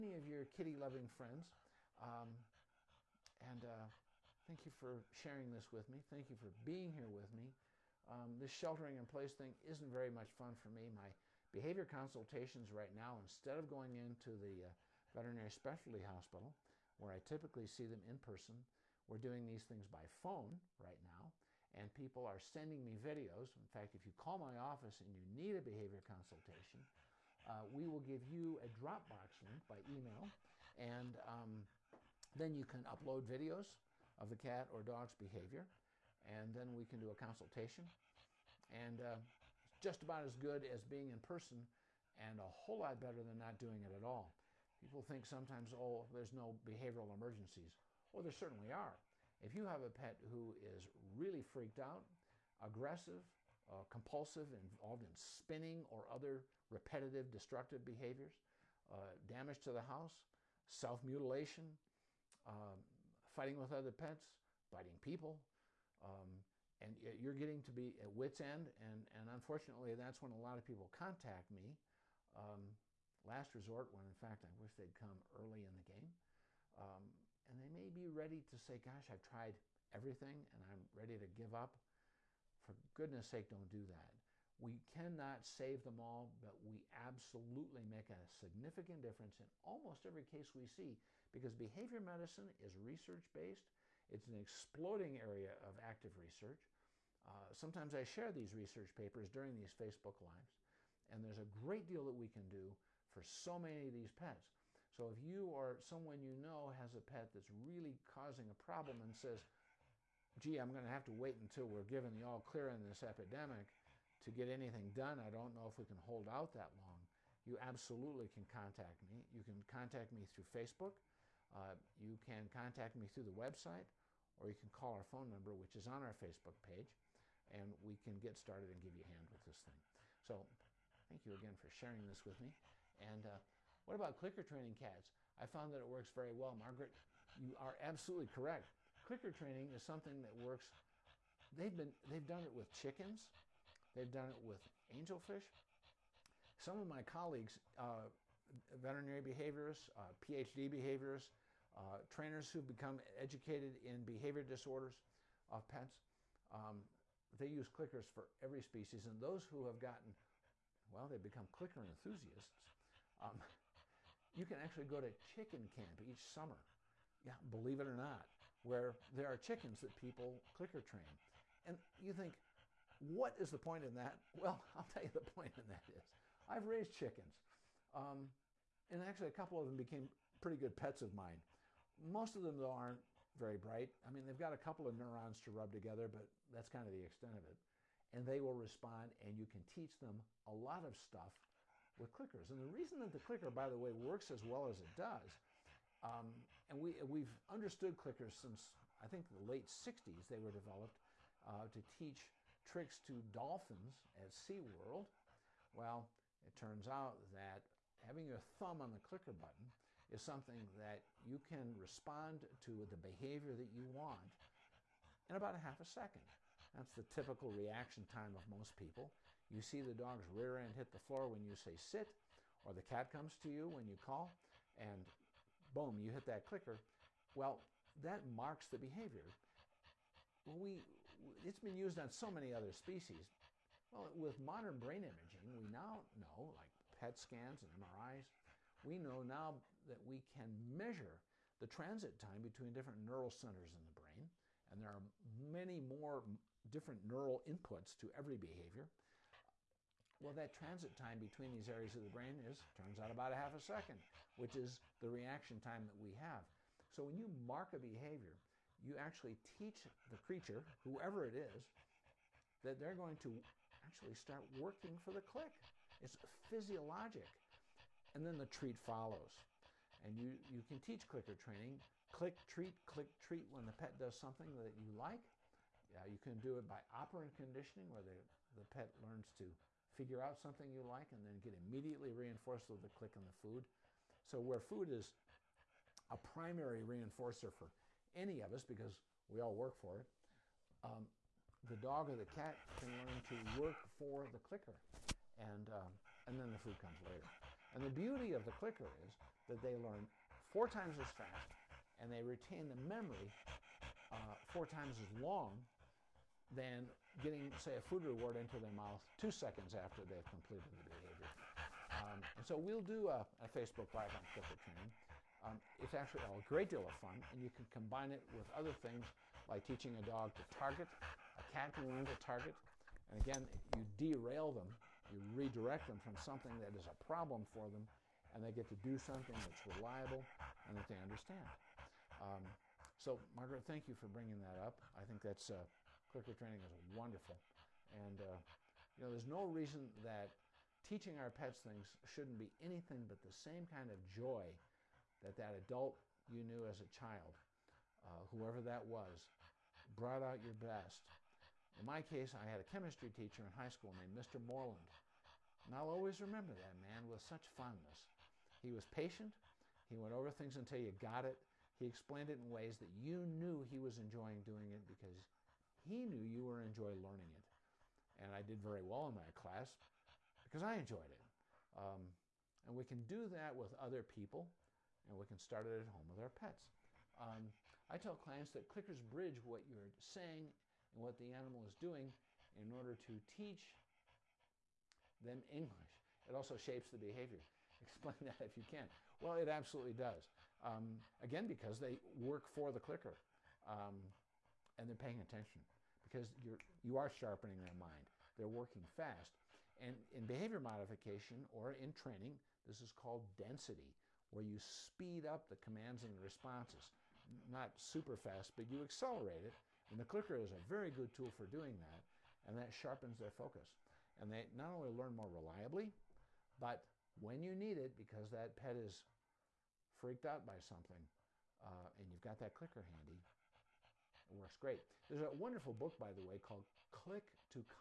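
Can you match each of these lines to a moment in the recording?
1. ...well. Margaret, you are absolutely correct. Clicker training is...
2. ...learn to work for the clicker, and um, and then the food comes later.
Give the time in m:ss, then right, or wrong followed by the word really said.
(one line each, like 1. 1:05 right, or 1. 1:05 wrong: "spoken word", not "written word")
1. 2:16 right
2. 4:53 right.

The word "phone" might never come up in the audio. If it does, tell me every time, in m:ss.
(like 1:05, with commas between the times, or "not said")
0:20, 2:05.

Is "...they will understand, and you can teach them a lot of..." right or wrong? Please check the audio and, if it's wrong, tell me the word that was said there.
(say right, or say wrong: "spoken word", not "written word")
wrong: "respond", not "understand".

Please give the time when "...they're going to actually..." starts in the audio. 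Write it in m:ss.
4:22.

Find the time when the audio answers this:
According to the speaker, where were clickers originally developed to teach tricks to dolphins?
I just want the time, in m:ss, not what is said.
3:24.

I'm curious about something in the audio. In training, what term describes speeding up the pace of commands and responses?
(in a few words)
density.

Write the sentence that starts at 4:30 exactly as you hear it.
And you, you can teach clicker training.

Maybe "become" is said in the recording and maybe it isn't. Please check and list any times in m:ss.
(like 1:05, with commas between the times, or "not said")
2:32, 2:41.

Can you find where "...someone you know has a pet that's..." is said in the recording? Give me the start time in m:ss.
1:45.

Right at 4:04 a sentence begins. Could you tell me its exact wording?
And there are many more different neural inputs to every behavior.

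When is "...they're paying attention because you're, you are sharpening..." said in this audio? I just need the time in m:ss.
6:34.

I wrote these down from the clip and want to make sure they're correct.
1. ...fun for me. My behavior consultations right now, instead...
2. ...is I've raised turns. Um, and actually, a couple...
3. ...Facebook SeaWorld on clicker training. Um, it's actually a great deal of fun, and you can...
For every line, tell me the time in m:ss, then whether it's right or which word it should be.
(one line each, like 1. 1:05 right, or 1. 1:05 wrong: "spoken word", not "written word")
1. 0:10 right
2. 2:55 wrong: "chickens", not "turns"
3. 5:13 wrong: "Live", not "SeaWorld".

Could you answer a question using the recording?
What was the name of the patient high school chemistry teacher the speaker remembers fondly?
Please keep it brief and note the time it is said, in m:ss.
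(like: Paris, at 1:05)
Mr. Moreland, at 5:54.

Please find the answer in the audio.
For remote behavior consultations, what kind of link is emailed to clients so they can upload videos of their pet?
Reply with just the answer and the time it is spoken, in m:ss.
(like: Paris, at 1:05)
Dropbox link, at 0:28.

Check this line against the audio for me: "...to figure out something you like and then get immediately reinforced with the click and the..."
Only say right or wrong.
right.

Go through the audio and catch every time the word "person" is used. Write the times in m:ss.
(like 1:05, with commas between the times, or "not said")
0:18, 0:41.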